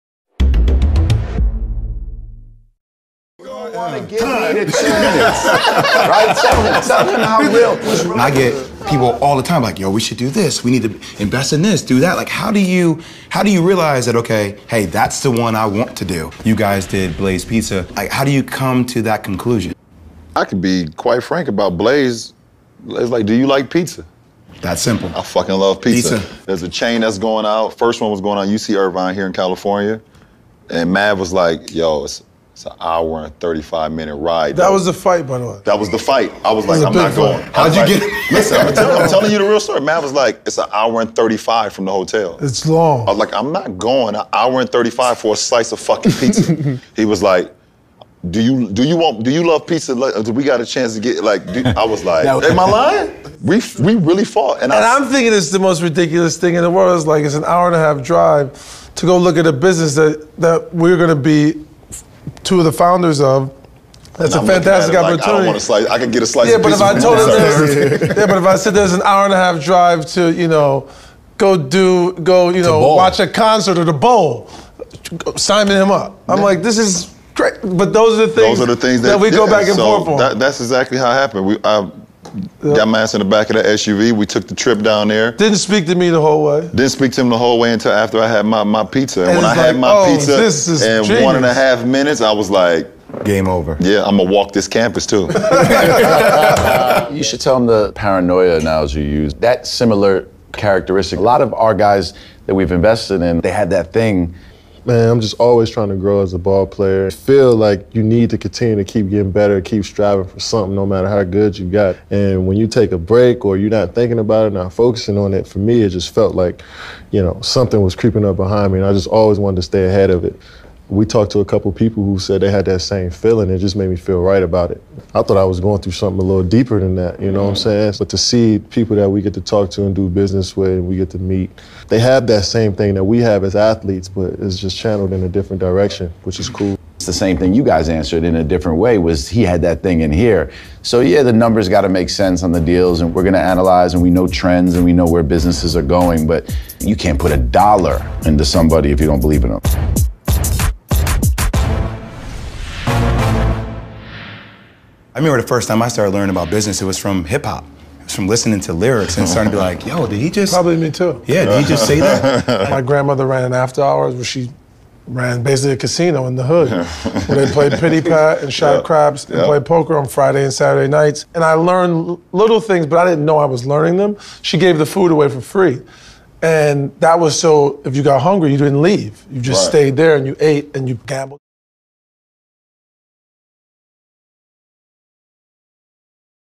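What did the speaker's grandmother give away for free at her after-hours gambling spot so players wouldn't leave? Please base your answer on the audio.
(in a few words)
The food.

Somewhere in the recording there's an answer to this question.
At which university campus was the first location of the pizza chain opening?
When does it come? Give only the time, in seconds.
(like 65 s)
28 s.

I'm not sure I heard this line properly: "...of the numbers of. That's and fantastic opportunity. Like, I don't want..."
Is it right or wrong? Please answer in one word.
wrong.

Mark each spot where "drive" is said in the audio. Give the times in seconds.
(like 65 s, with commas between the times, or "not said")
58 s, 69 s.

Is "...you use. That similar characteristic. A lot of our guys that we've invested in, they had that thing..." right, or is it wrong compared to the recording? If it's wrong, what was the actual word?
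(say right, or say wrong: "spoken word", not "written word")
right.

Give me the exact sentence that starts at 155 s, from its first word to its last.
I remember the first time I started learning about business, it was from hip hop.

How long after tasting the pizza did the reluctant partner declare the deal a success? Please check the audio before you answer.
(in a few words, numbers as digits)
1.5 minutes.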